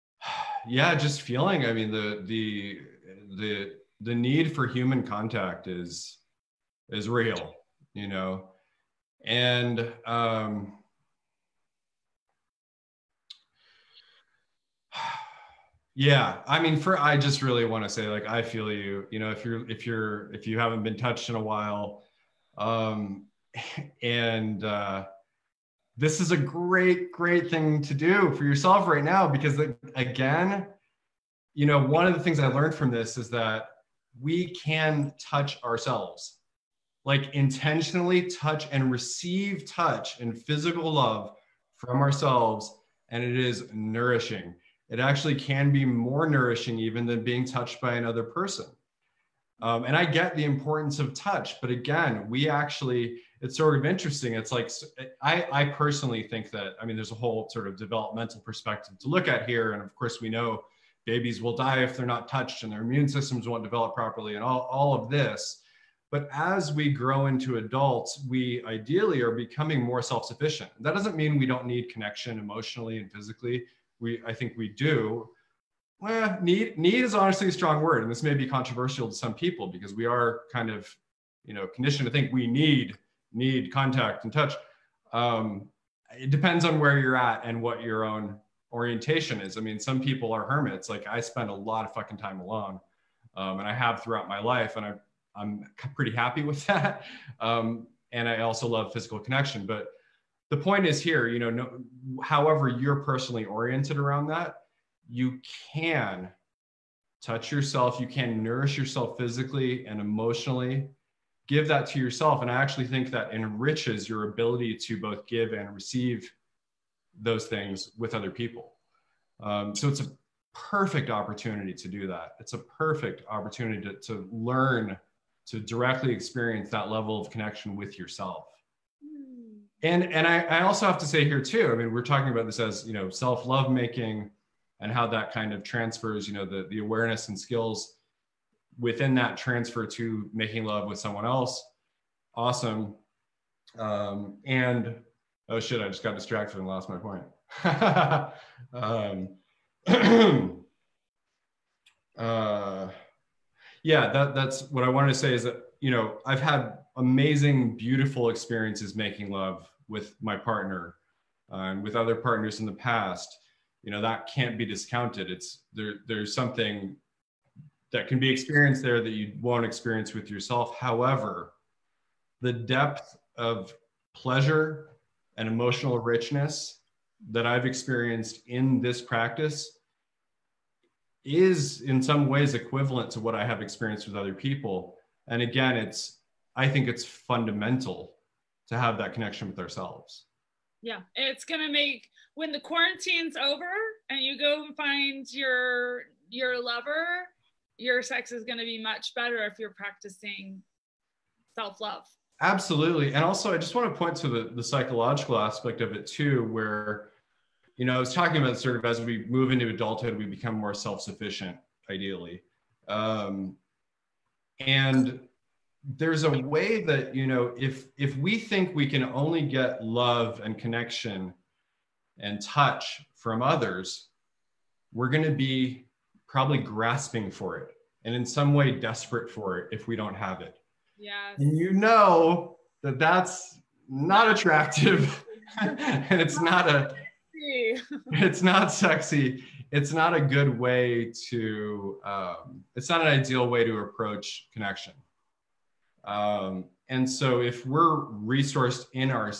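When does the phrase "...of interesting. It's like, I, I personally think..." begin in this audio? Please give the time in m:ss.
0:53.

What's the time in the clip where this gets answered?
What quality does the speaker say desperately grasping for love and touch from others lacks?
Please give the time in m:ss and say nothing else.
3:54.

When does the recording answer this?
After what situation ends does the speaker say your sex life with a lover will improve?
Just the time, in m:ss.
3:12.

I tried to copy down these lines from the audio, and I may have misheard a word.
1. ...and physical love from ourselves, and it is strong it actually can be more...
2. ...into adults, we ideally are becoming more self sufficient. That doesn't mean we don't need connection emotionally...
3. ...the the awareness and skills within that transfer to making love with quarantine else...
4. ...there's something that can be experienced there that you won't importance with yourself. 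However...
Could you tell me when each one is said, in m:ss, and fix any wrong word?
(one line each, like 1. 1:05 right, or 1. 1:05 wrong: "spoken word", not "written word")
1. 0:40 wrong: "nourishing", not "strong"
2. 1:07 right
3. 2:16 wrong: "someone", not "quarantine"
4. 2:46 wrong: "experience", not "importance".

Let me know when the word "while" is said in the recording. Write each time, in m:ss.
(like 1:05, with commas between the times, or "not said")
0:21.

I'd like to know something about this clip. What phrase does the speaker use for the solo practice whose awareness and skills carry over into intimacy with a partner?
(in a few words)
self love making.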